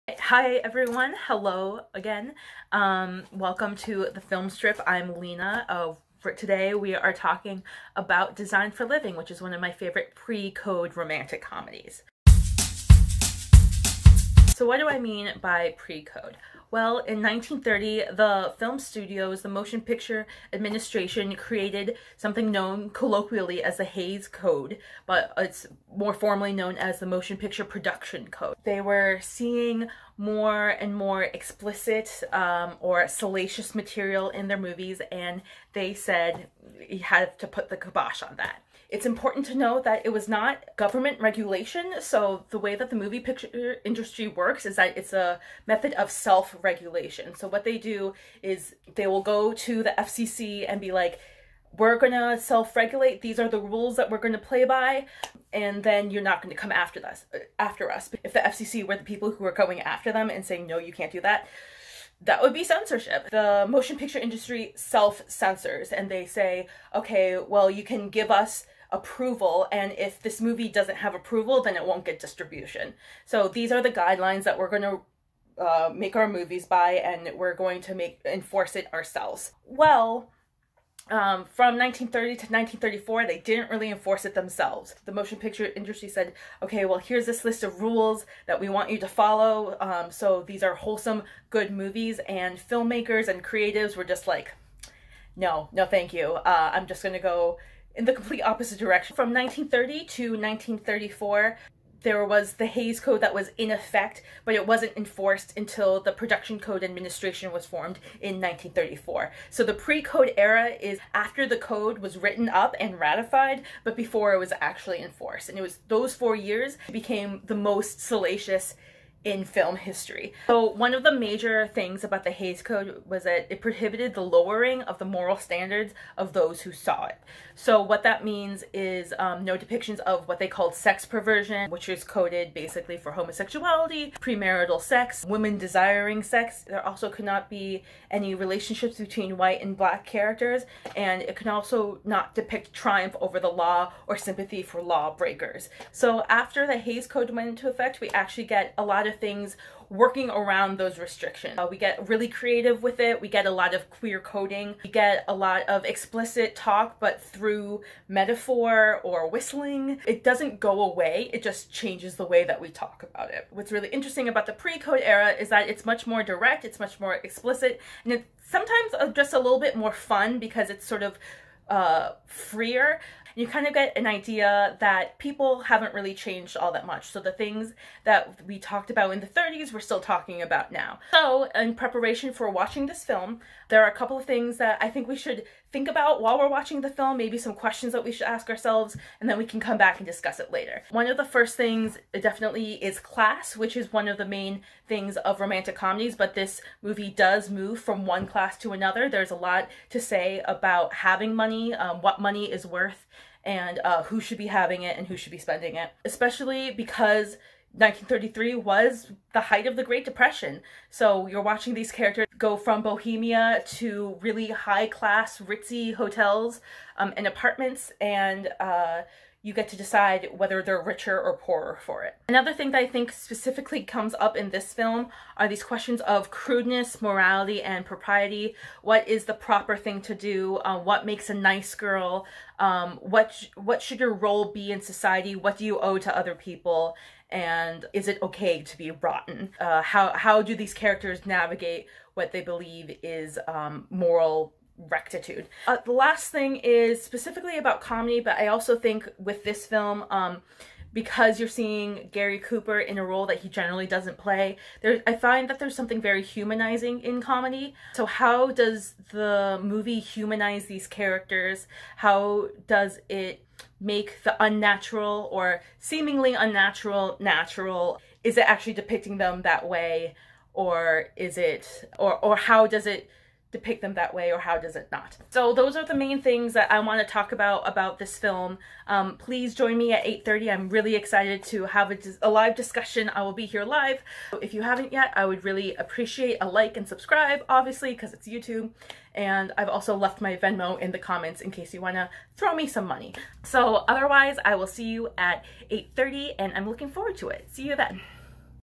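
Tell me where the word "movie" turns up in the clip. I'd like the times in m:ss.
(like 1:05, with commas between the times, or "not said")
0:34, 0:42, 1:10, 1:16, 1:31, 3:16, 4:19.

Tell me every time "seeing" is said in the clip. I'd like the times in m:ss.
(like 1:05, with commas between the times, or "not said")
0:29, 4:11.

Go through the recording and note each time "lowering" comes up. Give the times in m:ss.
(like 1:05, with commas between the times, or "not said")
2:04.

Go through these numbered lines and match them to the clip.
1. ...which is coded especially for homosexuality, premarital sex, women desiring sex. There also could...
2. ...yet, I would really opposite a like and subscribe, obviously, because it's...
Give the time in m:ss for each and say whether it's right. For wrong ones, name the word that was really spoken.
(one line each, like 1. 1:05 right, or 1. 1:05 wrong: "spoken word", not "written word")
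1. 2:11 wrong: "basically", not "especially"
2. 4:44 wrong: "appreciate", not "opposite".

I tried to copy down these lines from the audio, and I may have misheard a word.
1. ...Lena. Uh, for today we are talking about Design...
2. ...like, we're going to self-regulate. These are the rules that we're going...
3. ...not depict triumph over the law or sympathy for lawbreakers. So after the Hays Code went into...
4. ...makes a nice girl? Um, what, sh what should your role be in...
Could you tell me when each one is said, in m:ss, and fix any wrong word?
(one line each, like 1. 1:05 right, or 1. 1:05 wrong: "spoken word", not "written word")
1. 0:05 right
2. 0:50 right
3. 2:22 right
4. 3:51 right.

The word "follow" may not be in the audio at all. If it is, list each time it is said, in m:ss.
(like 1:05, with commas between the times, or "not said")
1:29.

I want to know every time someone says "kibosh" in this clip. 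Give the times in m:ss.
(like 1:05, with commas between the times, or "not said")
0:37.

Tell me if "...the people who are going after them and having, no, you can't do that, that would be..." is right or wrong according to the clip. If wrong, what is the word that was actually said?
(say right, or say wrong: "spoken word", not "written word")
wrong: "saying", not "having".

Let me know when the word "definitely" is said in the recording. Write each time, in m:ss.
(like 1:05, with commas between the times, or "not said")
3:12.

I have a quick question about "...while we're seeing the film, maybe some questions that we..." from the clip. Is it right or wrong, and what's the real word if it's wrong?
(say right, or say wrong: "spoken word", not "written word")
wrong: "watching", not "seeing".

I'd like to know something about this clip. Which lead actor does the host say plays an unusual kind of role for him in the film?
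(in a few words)
Gary Cooper.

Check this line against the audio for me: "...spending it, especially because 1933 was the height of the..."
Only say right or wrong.
right.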